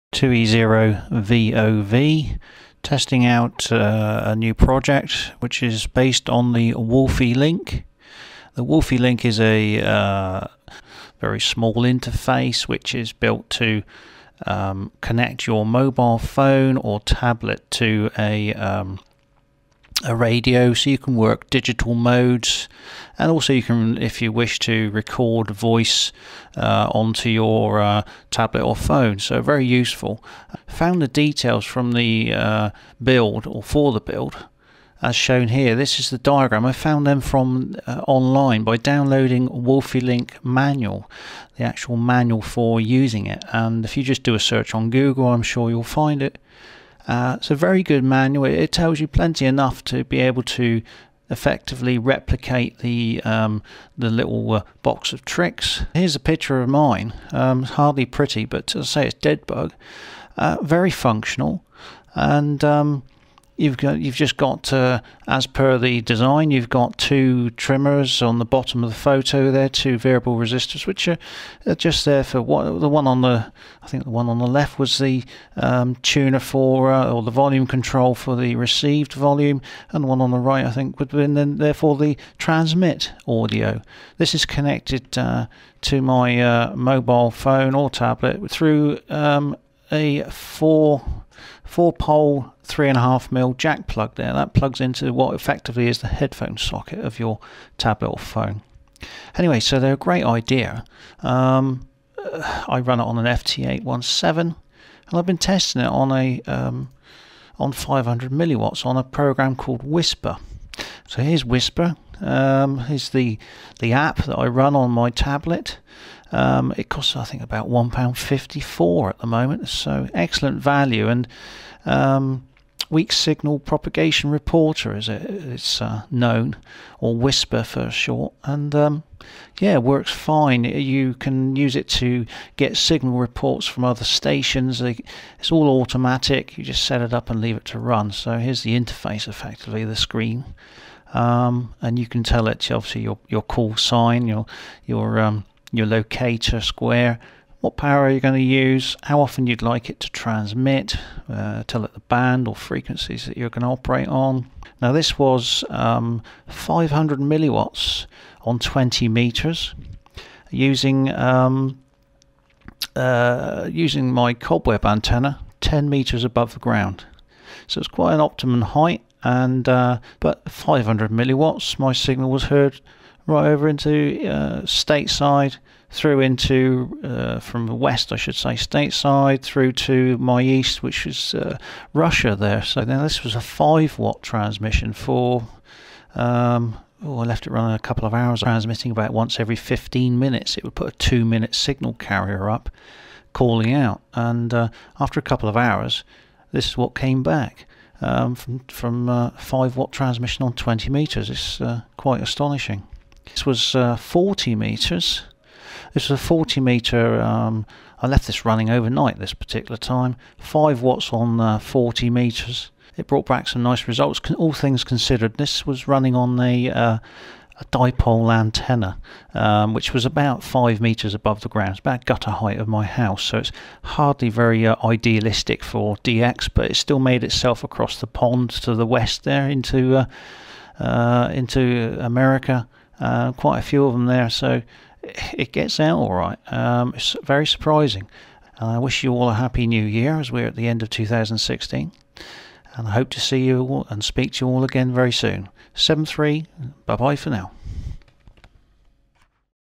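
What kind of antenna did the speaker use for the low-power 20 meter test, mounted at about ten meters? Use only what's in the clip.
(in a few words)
cobweb antenna.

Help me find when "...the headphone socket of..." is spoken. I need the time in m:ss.
1:35.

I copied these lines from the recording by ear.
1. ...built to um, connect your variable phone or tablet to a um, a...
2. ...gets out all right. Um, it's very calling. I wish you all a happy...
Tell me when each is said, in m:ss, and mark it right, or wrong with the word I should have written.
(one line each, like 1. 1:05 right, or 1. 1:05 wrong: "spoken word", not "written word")
1. 0:13 wrong: "mobile", not "variable"
2. 3:55 wrong: "surprising", not "calling".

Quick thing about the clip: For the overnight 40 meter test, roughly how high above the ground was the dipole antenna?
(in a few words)
5 meters.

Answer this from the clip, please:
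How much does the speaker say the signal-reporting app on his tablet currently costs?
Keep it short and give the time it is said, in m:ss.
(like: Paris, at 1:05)
£1.54, at 1:57.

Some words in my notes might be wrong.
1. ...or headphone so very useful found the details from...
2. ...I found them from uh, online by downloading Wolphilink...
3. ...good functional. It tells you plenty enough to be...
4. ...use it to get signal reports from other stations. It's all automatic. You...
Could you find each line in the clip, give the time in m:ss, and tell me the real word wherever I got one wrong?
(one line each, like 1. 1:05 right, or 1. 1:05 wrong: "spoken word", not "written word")
1. 0:28 wrong: "phone", not "headphone"
2. 0:36 right
3. 0:47 wrong: "manual", not "functional"
4. 2:11 right.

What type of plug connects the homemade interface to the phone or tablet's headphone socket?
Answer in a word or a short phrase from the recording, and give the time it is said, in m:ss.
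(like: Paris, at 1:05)
four pole, 3.5 mm jack, at 1:31.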